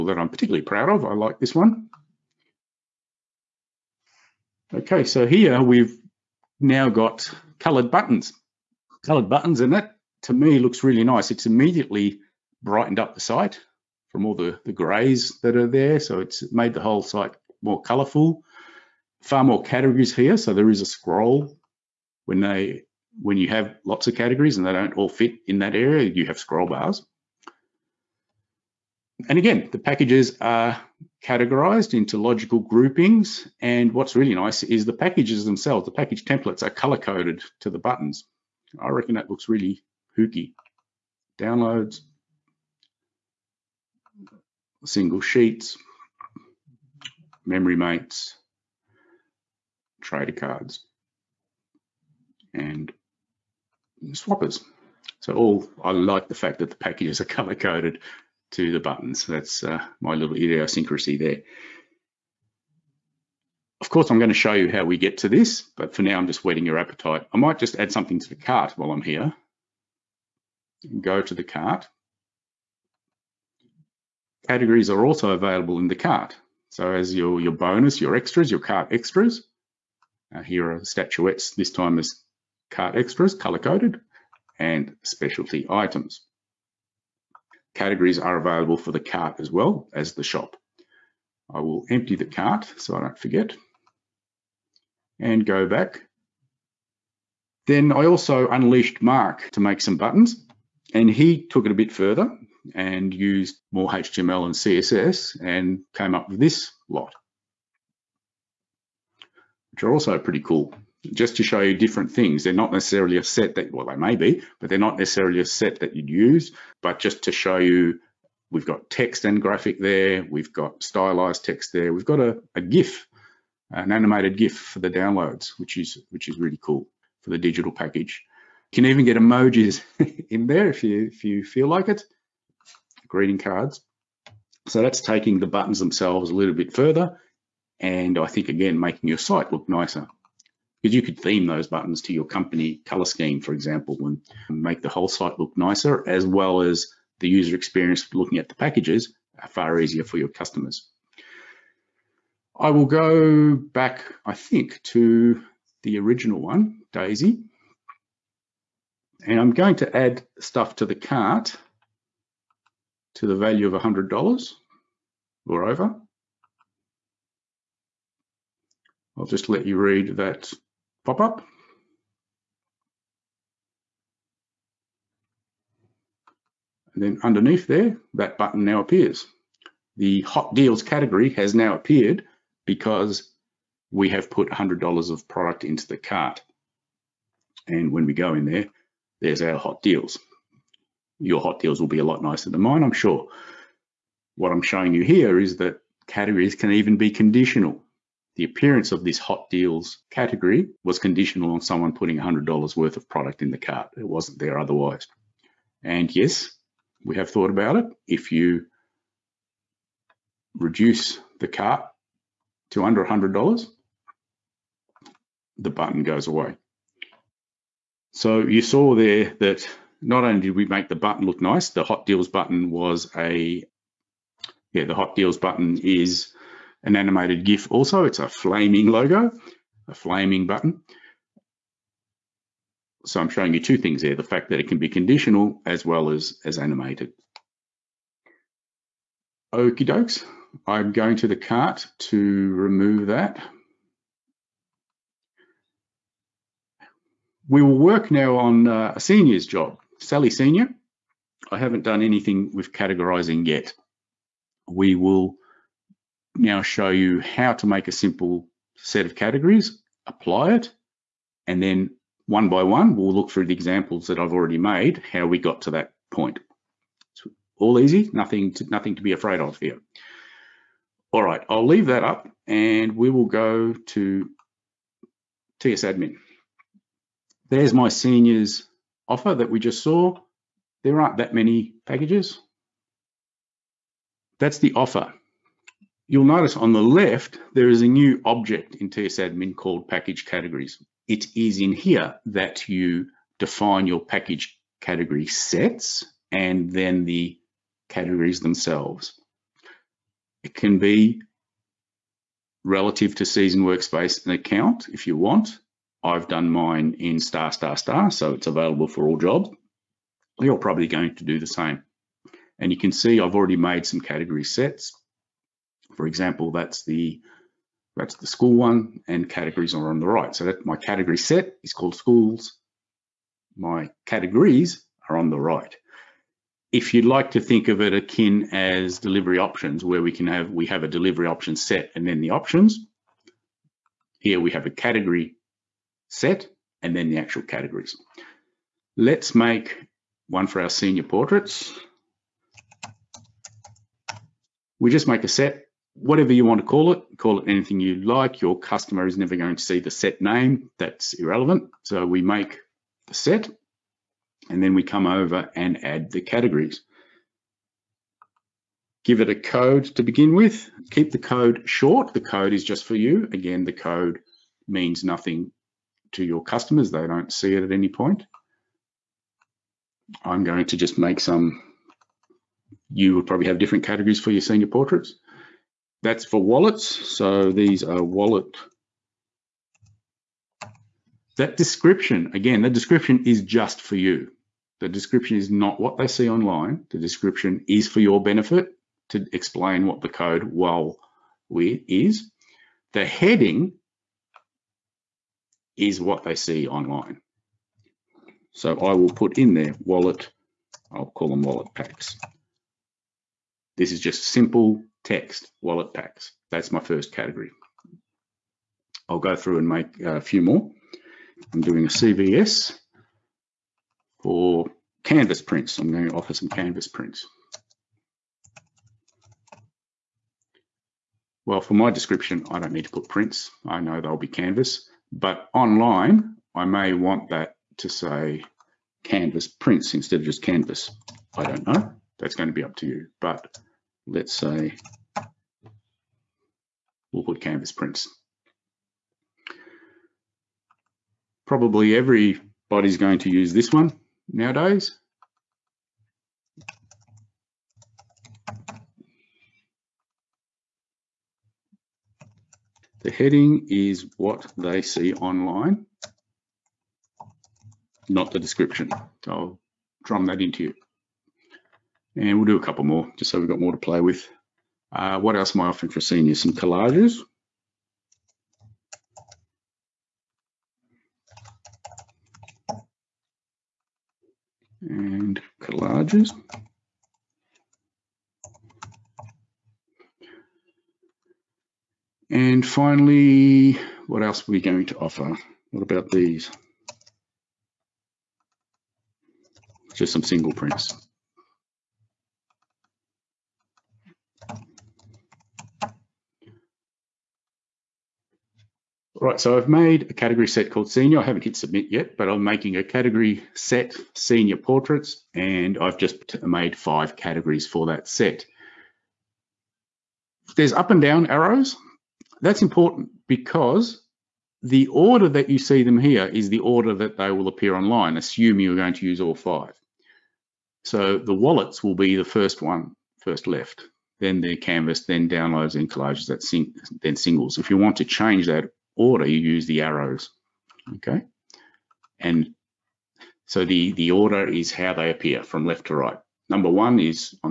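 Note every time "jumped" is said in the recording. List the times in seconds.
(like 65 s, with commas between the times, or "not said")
not said.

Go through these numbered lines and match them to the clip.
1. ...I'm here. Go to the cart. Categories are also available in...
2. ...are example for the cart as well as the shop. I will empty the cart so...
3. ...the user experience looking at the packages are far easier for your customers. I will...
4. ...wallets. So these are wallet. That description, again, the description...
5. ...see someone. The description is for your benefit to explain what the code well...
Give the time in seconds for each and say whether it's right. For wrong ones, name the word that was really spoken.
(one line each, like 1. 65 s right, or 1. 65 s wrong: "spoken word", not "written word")
1. 68 s right
2. 88 s wrong: "available", not "example"
3. 147 s right
4. 376 s right
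5. 386 s wrong: "online", not "someone".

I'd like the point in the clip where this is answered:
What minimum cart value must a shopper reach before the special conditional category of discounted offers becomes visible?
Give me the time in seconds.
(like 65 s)
163 s.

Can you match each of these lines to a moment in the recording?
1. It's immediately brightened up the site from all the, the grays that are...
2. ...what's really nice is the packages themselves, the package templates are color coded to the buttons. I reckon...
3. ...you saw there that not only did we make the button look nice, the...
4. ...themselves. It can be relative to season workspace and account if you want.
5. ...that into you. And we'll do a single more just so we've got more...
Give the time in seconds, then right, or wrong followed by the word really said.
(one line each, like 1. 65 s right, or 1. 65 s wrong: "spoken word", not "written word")
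1. 11 s right
2. 33 s right
3. 218 s right
4. 298 s right
5. 460 s wrong: "couple", not "single".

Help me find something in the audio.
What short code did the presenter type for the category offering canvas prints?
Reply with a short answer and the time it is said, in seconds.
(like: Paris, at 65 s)
CVS, at 411 s.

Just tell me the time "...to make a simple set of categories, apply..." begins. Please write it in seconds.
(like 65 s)
257 s.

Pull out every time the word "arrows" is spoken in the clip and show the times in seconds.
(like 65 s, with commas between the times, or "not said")
511 s, 529 s.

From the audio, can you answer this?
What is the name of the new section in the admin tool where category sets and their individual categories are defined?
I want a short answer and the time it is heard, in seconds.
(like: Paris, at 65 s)
package categories, at 289 s.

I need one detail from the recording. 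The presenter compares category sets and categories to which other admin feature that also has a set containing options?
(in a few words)
delivery options.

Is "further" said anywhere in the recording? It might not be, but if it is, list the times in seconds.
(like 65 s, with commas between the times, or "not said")
101 s, 136 s.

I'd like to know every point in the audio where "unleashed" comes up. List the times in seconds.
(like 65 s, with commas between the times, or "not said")
98 s.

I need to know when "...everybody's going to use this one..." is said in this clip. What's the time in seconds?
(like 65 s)
441 s.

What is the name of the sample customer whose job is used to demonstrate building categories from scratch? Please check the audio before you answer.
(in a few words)
Sally Senior.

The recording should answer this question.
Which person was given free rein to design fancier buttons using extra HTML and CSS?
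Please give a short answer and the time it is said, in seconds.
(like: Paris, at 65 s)
Mark, at 99 s.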